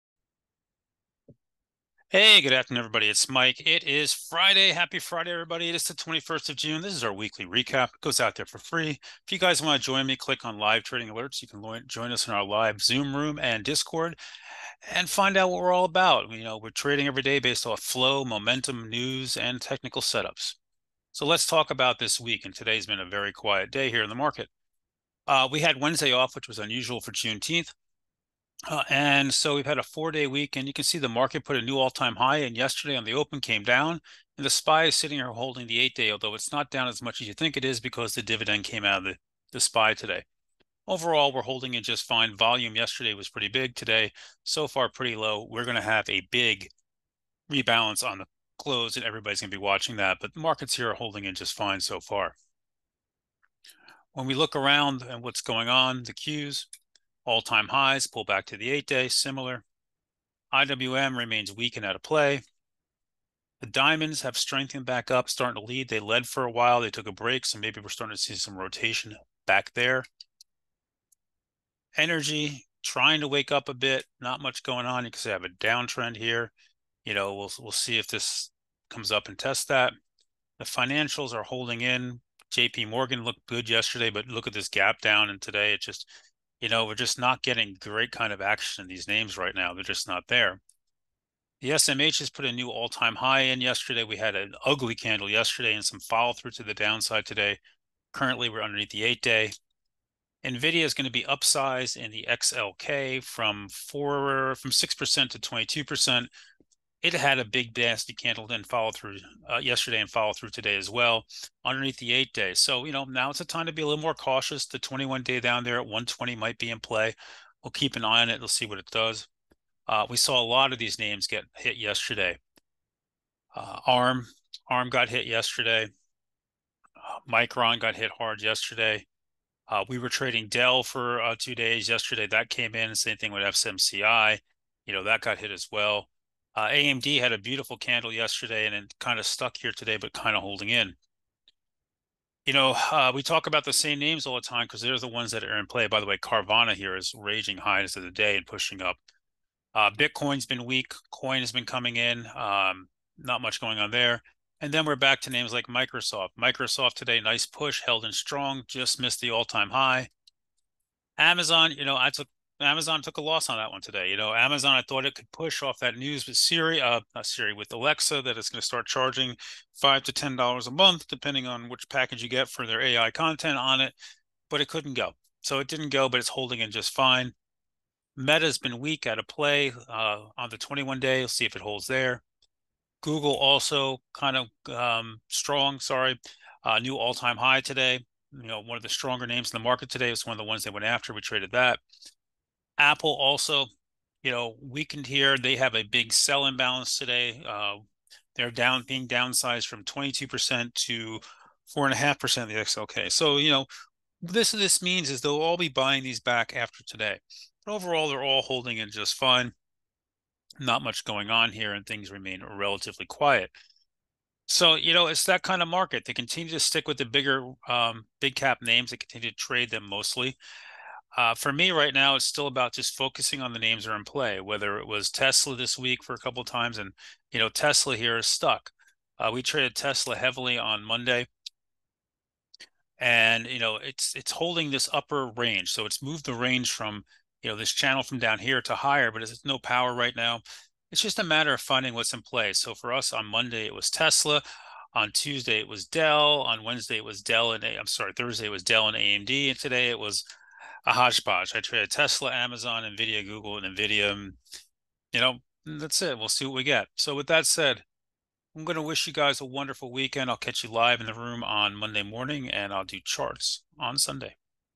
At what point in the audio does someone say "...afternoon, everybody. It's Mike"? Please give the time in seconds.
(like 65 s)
2 s.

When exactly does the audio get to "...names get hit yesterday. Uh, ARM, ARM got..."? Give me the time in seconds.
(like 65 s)
120 s.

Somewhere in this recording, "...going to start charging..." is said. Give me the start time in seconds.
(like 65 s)
168 s.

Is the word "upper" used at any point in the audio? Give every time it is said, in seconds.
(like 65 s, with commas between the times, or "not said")
234 s.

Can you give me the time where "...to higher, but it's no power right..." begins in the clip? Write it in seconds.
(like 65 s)
238 s.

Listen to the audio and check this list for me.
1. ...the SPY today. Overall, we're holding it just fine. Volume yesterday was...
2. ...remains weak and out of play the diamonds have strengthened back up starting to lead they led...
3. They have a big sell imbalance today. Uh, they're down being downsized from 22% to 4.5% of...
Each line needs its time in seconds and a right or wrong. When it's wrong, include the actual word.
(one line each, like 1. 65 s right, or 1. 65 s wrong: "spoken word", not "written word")
1. 39 s right
2. 61 s right
3. 195 s right.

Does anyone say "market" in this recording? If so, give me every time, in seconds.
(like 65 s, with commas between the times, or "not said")
24 s, 31 s, 50 s, 189 s, 215 s.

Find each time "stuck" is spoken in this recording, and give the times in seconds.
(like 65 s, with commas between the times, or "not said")
139 s, 228 s.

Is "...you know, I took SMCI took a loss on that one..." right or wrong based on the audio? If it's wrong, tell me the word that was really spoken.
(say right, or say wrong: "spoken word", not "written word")
wrong: "Amazon", not "SMCI".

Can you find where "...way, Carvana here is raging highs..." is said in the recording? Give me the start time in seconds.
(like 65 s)
146 s.